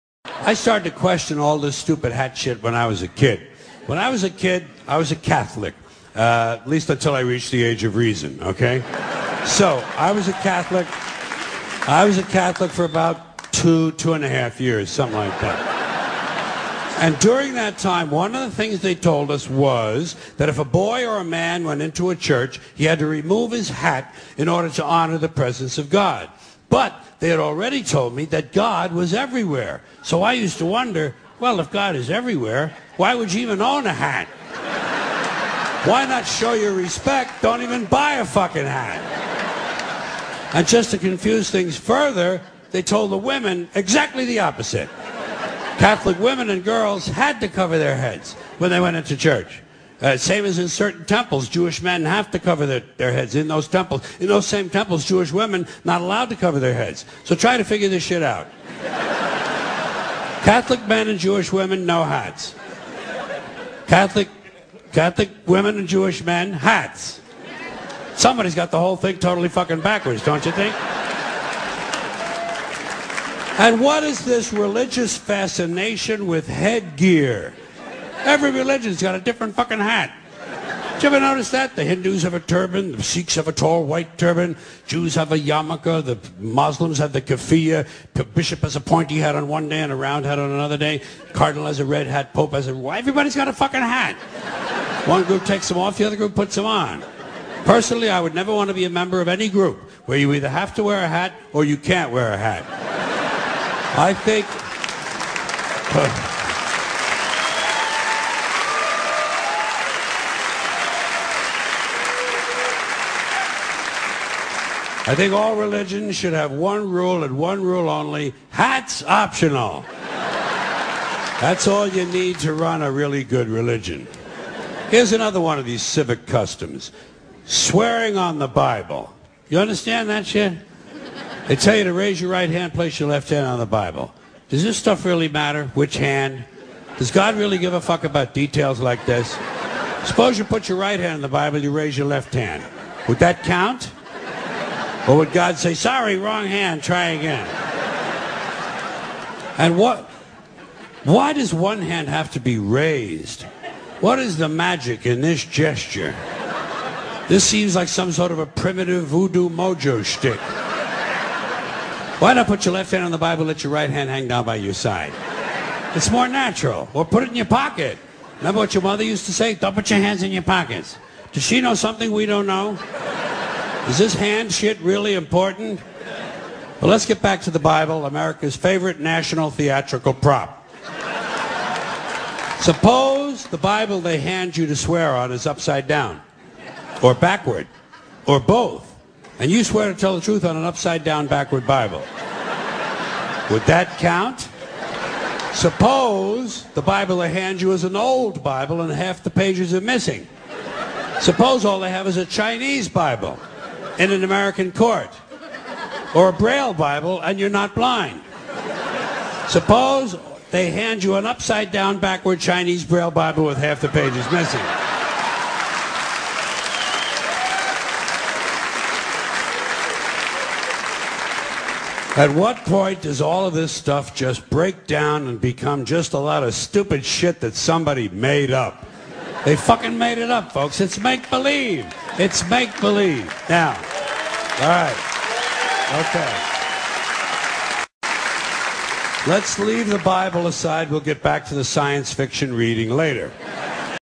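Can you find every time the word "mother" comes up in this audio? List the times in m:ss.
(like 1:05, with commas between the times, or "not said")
2:48.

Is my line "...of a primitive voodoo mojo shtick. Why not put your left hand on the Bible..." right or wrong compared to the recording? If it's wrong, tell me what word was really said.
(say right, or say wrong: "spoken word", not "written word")
right.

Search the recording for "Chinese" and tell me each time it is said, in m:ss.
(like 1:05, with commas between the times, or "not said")
3:22, 3:32.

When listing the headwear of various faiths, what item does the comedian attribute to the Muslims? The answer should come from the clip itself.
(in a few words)
keffiyeh.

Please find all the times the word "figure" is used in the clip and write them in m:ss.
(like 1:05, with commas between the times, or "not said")
0:57.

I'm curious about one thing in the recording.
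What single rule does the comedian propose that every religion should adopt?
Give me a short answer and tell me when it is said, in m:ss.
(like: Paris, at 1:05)
Hats optional, at 1:58.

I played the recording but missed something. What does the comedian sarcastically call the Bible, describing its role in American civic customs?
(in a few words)
America's favorite national theatrical prop.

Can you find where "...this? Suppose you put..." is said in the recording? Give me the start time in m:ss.
2:19.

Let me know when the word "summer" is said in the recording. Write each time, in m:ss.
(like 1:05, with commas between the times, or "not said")
not said.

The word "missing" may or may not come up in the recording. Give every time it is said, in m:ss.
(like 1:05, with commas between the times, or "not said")
3:19, 3:34.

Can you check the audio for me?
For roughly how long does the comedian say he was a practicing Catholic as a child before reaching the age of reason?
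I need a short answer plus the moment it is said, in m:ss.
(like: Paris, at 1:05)
2 and a half years, at 0:13.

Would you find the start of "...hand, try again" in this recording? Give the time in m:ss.
2:26.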